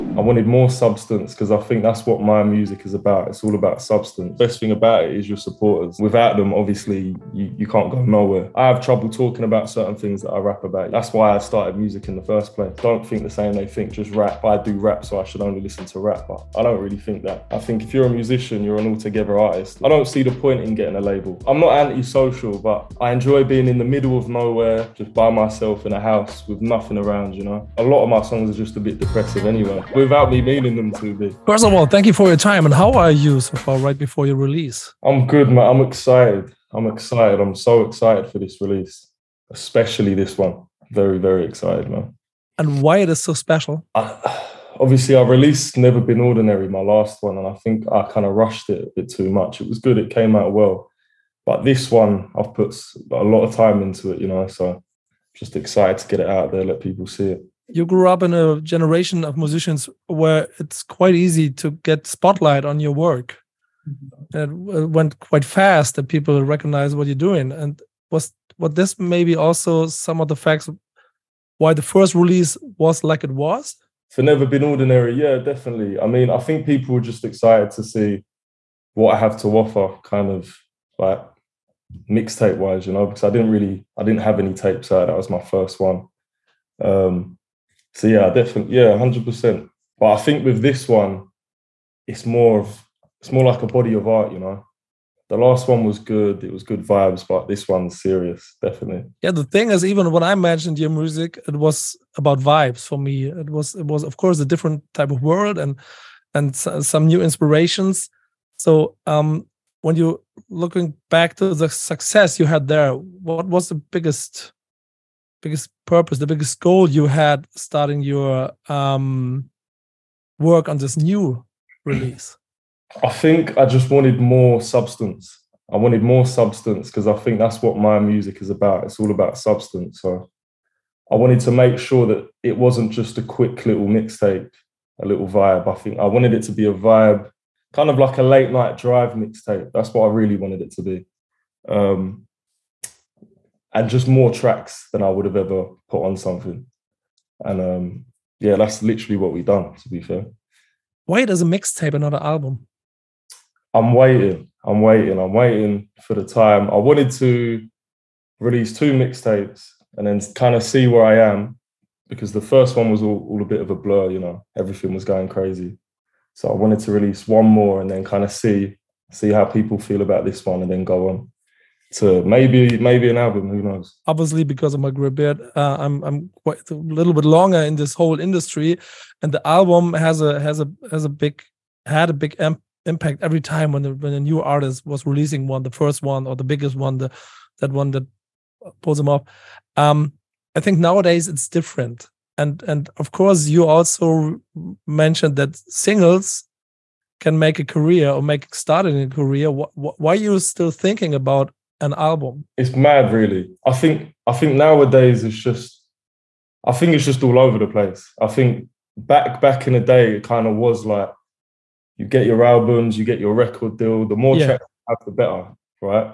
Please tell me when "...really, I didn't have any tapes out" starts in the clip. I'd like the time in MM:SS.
01:23.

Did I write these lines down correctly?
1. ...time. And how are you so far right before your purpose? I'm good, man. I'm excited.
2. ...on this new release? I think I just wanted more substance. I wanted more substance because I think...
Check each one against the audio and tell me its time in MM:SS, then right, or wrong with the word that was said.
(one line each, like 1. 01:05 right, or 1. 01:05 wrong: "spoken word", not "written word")
1. 00:32 wrong: "release", not "purpose"
2. 02:00 right.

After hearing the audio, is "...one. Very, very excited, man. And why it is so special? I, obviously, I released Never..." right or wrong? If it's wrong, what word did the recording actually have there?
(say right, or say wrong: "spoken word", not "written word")
right.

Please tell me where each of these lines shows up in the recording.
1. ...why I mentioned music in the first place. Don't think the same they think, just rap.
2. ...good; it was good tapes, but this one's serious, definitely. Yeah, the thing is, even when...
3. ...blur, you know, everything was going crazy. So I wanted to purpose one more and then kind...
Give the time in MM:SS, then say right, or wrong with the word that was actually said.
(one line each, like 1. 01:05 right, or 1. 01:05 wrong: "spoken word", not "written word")
1. 00:11 wrong: "started", not "mentioned"
2. 01:35 wrong: "vibes", not "tapes"
3. 02:43 wrong: "release", not "purpose".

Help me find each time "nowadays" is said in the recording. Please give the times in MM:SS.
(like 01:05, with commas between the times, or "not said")
03:10, 03:24.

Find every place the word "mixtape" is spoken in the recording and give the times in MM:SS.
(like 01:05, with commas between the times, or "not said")
01:22, 02:13, 02:19, 02:31, 02:38.